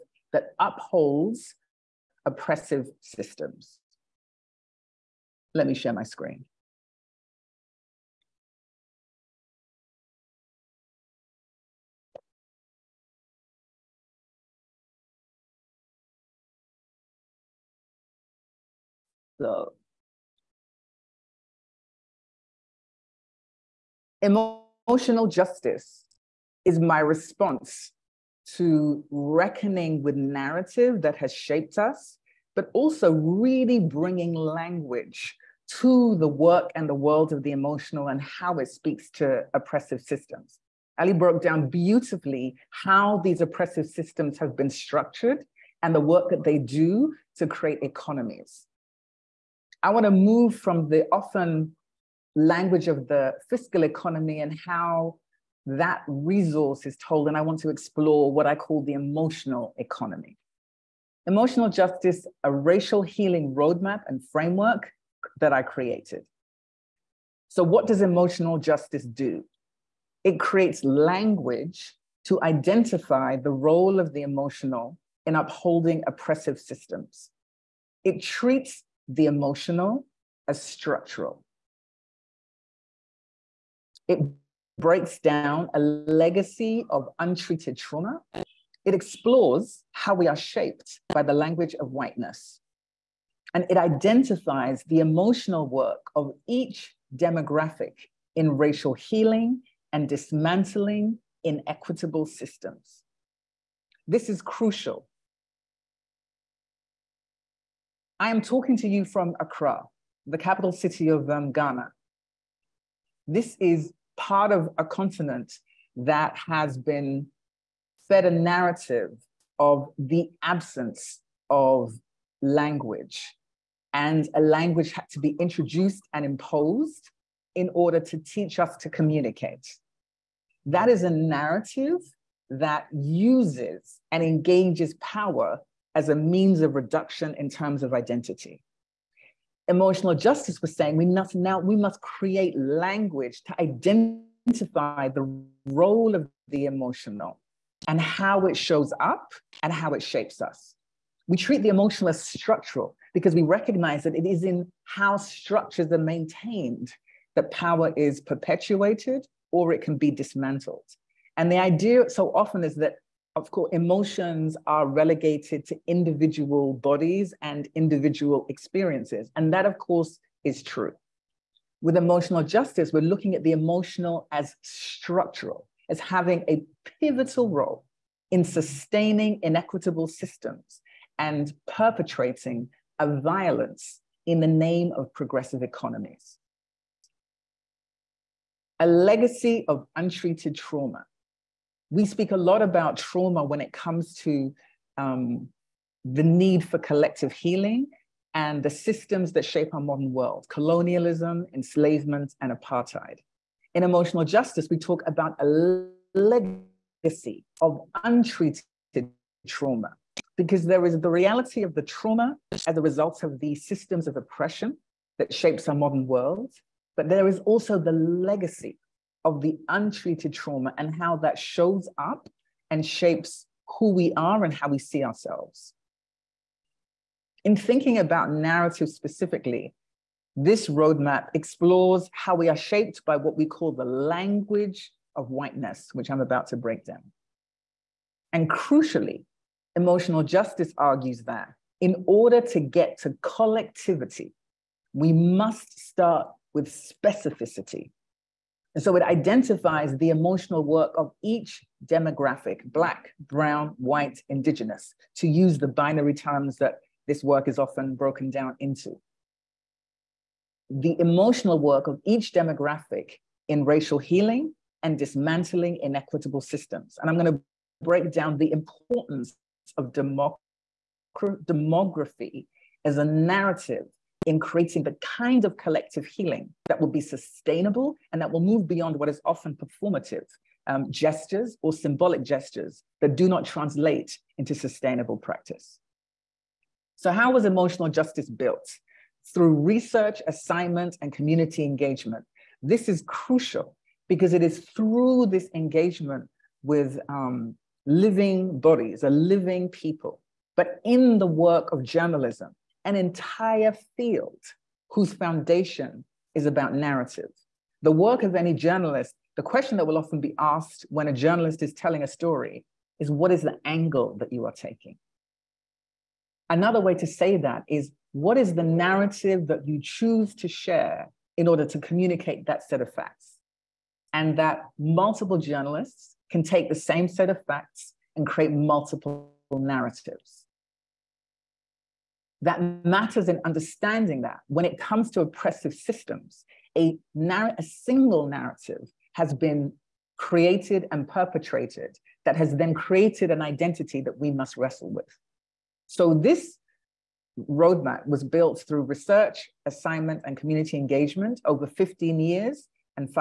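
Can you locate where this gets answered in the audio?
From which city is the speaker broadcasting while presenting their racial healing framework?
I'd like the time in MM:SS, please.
01:49.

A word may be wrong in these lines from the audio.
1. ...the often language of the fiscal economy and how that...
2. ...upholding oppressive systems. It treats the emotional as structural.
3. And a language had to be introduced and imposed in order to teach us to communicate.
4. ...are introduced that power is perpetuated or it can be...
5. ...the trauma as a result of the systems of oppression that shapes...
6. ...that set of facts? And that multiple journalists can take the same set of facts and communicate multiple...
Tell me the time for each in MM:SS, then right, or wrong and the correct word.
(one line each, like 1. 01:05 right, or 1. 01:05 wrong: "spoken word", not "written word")
1. 00:50 right
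2. 01:15 right
3. 02:03 right
4. 02:35 wrong: "maintained", not "introduced"
5. 03:31 right
6. 05:22 wrong: "create", not "communicate".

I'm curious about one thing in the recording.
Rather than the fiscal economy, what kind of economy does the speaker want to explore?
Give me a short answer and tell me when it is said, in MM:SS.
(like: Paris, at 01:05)
emotional economy, at 00:58.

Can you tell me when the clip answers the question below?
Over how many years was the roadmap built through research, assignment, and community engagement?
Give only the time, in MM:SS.
05:51.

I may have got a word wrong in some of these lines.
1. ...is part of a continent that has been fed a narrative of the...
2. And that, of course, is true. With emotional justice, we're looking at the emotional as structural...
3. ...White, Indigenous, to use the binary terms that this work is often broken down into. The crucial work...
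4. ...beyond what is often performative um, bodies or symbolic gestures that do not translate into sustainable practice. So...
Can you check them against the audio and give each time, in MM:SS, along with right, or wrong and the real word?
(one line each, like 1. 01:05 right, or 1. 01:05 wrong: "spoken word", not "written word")
1. 01:53 right
2. 02:49 right
3. 04:13 wrong: "emotional", not "crucial"
4. 04:38 wrong: "gestures", not "bodies".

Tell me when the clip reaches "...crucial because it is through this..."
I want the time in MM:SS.
04:53.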